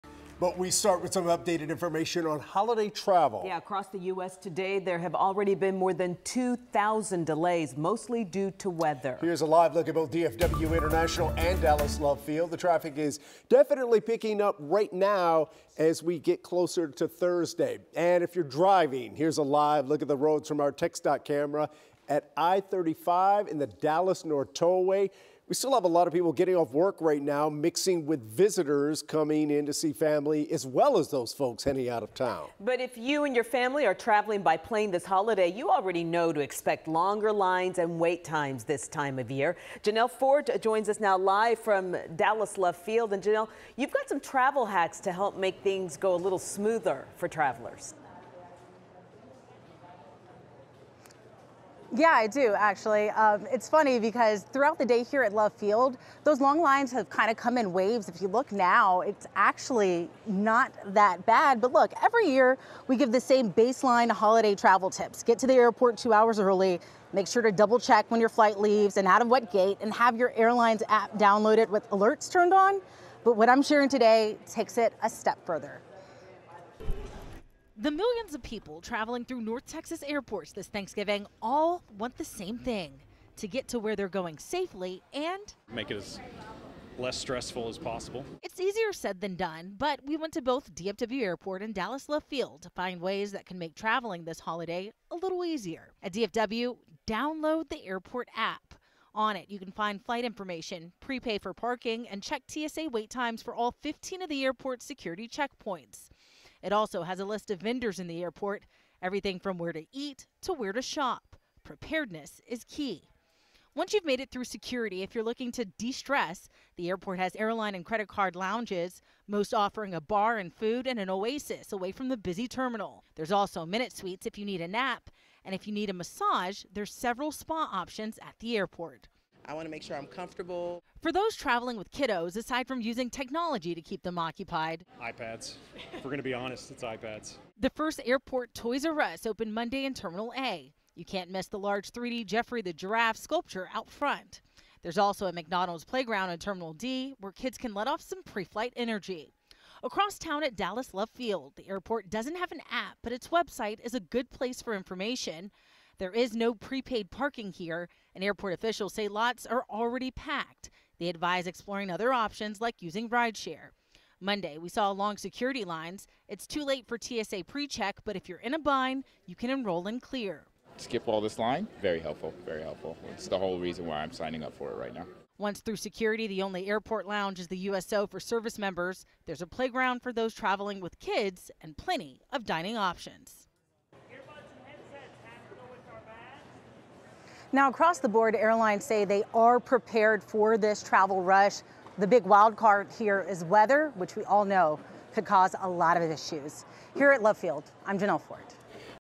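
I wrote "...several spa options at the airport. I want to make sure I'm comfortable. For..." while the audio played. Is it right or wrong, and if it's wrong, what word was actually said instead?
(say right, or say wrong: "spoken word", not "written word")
right.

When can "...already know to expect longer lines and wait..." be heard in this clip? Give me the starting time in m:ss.
0:35.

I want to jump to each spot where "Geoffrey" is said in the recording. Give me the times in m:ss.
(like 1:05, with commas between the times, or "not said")
2:22.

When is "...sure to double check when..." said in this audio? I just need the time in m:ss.
1:07.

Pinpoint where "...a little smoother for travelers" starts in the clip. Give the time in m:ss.
0:46.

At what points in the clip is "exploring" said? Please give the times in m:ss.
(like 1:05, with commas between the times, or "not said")
2:41.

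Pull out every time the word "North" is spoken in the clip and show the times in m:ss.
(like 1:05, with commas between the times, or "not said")
0:24, 1:19.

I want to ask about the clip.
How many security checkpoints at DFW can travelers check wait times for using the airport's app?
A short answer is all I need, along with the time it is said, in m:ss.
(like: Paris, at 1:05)
15, at 1:43.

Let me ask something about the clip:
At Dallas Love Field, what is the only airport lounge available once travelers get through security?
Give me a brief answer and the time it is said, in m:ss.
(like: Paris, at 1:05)
USO, at 2:57.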